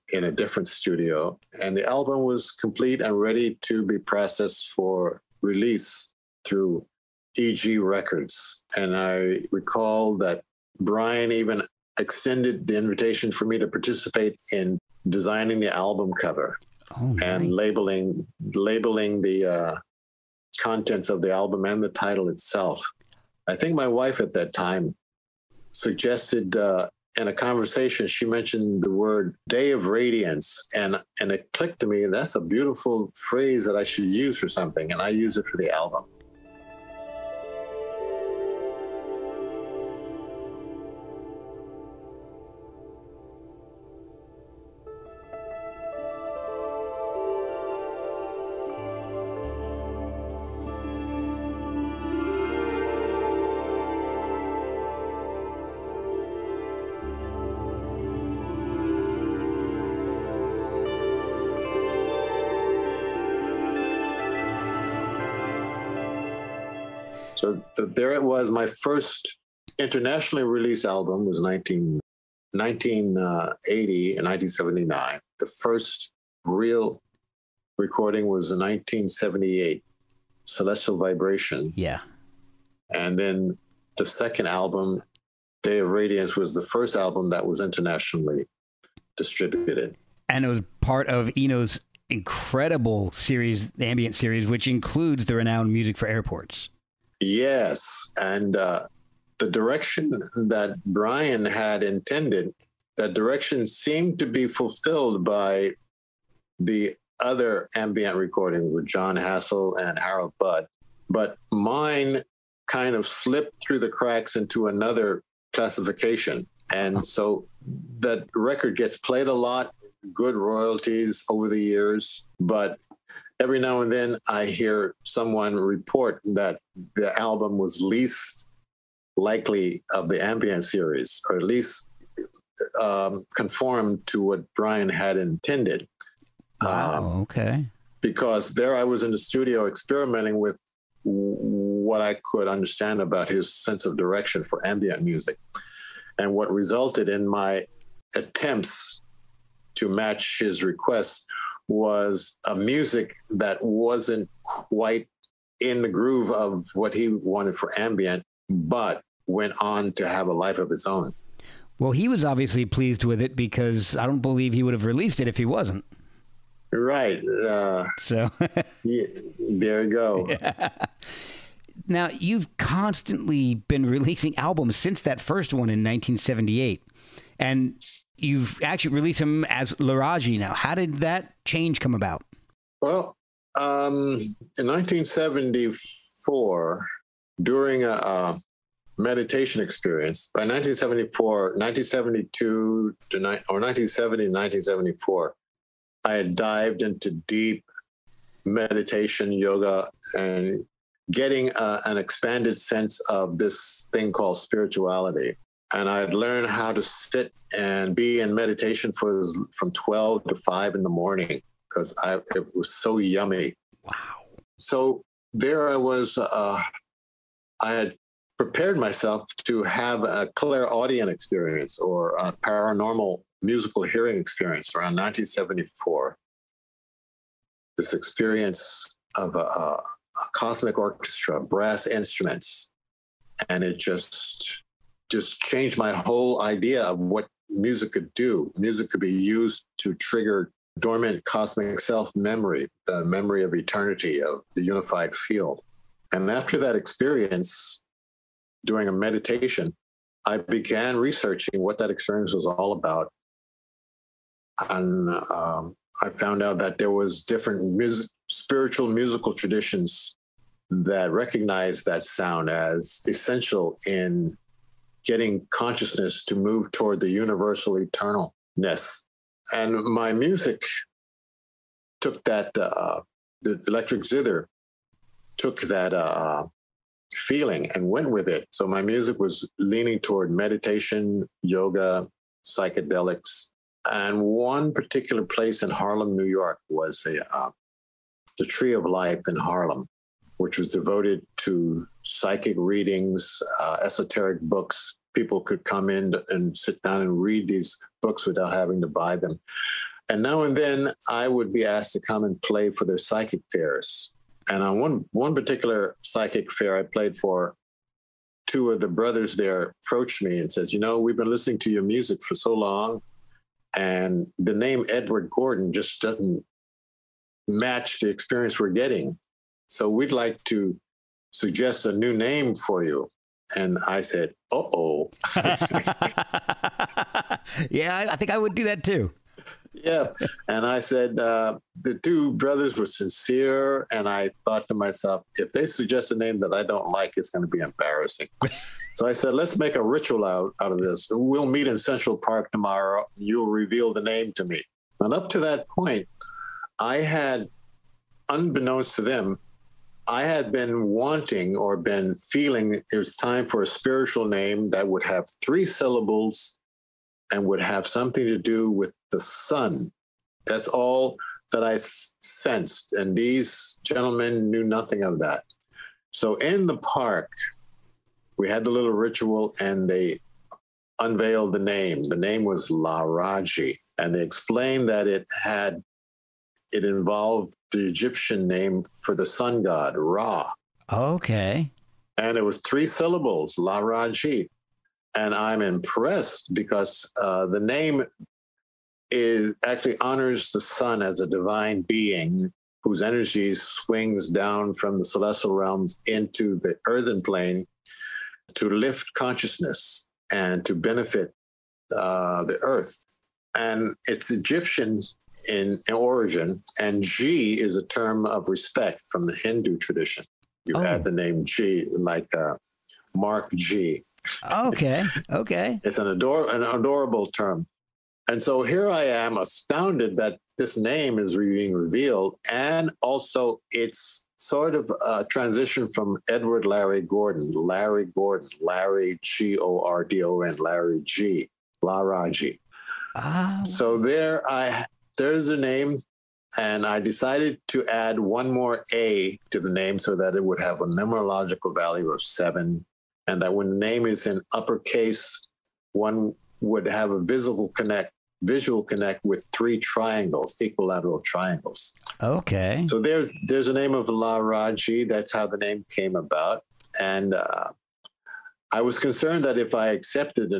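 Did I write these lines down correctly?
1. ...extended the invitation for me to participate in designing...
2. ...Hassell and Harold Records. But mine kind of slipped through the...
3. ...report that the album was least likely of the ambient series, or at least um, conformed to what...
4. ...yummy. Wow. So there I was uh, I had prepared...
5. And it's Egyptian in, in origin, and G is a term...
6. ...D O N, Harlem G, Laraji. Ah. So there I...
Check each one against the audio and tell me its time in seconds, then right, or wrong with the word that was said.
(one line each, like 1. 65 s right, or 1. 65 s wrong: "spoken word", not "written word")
1. 11 s right
2. 109 s wrong: "Budd", not "Records"
3. 125 s right
4. 212 s right
5. 403 s right
6. 430 s wrong: "Larry", not "Harlem".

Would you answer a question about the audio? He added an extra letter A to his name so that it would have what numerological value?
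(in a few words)
7.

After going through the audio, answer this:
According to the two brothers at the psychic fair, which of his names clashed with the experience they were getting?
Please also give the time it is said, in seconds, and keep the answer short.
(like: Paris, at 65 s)
Edward Gordon, at 314 s.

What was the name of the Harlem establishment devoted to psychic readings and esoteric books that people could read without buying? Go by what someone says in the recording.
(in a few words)
The Tree of Life.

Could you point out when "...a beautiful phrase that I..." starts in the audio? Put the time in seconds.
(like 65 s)
32 s.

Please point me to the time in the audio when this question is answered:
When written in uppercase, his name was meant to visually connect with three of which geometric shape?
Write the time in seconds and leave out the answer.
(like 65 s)
450 s.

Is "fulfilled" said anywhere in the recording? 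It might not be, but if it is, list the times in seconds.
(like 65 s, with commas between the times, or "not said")
104 s.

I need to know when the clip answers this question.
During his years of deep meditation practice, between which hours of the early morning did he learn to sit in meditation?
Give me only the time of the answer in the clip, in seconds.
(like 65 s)
209 s.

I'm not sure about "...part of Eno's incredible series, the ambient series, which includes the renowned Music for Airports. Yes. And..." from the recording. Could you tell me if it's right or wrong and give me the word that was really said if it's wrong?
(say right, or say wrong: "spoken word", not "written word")
right.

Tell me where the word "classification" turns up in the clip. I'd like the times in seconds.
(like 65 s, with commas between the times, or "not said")
115 s.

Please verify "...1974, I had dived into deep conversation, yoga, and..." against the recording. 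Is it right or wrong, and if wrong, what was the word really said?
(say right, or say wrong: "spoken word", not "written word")
wrong: "meditation", not "conversation".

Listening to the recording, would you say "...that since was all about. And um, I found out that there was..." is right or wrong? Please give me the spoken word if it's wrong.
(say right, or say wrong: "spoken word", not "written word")
wrong: "experience", not "since".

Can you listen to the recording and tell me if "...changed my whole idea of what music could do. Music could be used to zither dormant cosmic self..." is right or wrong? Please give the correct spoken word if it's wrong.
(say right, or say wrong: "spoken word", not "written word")
wrong: "trigger", not "zither".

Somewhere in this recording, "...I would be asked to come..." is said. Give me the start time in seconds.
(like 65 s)
301 s.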